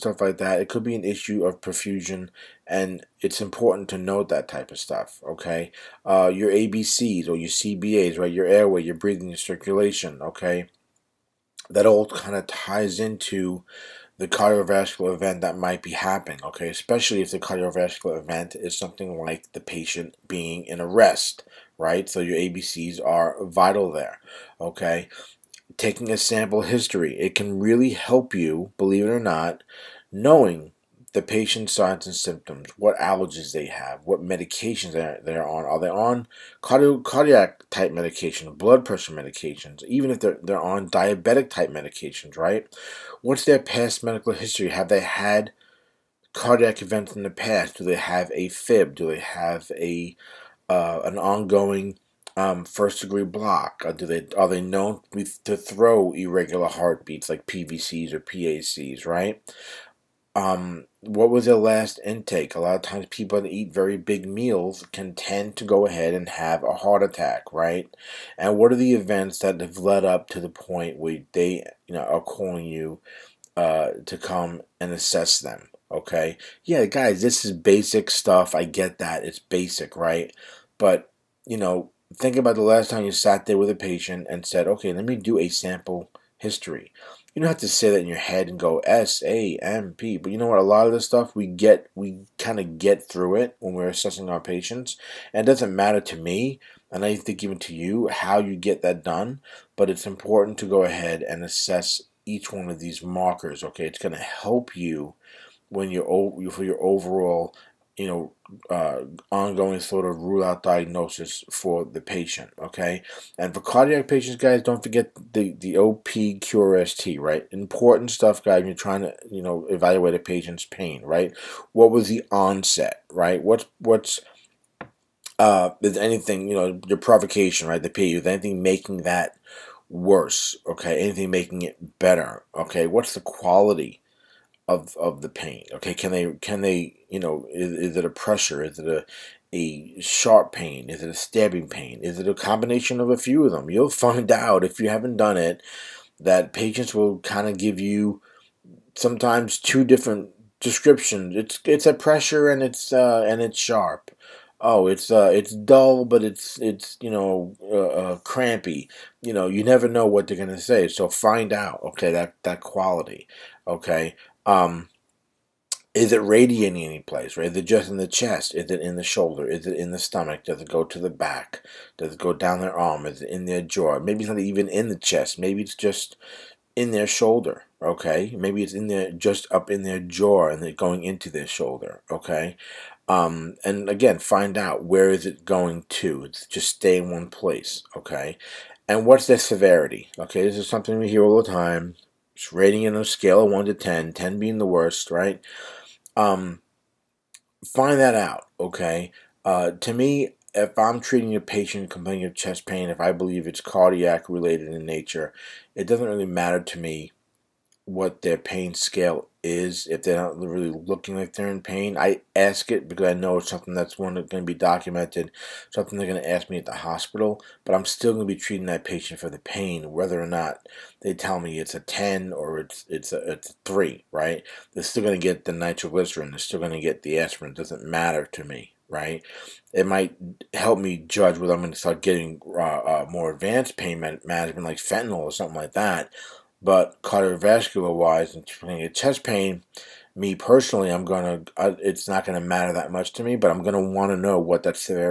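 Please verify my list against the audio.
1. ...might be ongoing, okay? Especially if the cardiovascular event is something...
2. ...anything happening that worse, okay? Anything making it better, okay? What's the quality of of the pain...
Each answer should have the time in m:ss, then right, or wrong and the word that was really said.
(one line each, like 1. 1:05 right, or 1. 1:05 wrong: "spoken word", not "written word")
1. 0:15 wrong: "happening", not "ongoing"
2. 2:08 wrong: "making", not "happening".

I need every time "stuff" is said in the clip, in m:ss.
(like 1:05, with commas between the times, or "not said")
0:04, 1:18, 1:31, 1:58.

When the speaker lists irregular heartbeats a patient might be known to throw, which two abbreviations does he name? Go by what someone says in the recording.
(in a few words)
PVCs or PACs.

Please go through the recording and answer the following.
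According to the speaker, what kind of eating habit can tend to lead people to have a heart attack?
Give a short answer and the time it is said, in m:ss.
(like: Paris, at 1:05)
very big meals, at 1:03.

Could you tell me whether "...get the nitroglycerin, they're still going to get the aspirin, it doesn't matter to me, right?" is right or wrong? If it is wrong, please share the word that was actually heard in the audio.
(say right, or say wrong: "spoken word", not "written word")
right.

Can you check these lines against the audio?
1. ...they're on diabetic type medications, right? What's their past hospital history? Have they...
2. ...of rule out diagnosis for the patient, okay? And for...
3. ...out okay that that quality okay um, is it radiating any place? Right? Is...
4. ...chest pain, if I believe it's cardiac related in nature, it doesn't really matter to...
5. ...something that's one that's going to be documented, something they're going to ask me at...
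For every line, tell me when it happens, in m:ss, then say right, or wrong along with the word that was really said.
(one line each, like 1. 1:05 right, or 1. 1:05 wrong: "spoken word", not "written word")
1. 0:40 wrong: "medical", not "hospital"
2. 1:50 right
3. 2:41 right
4. 3:22 right
5. 3:33 right.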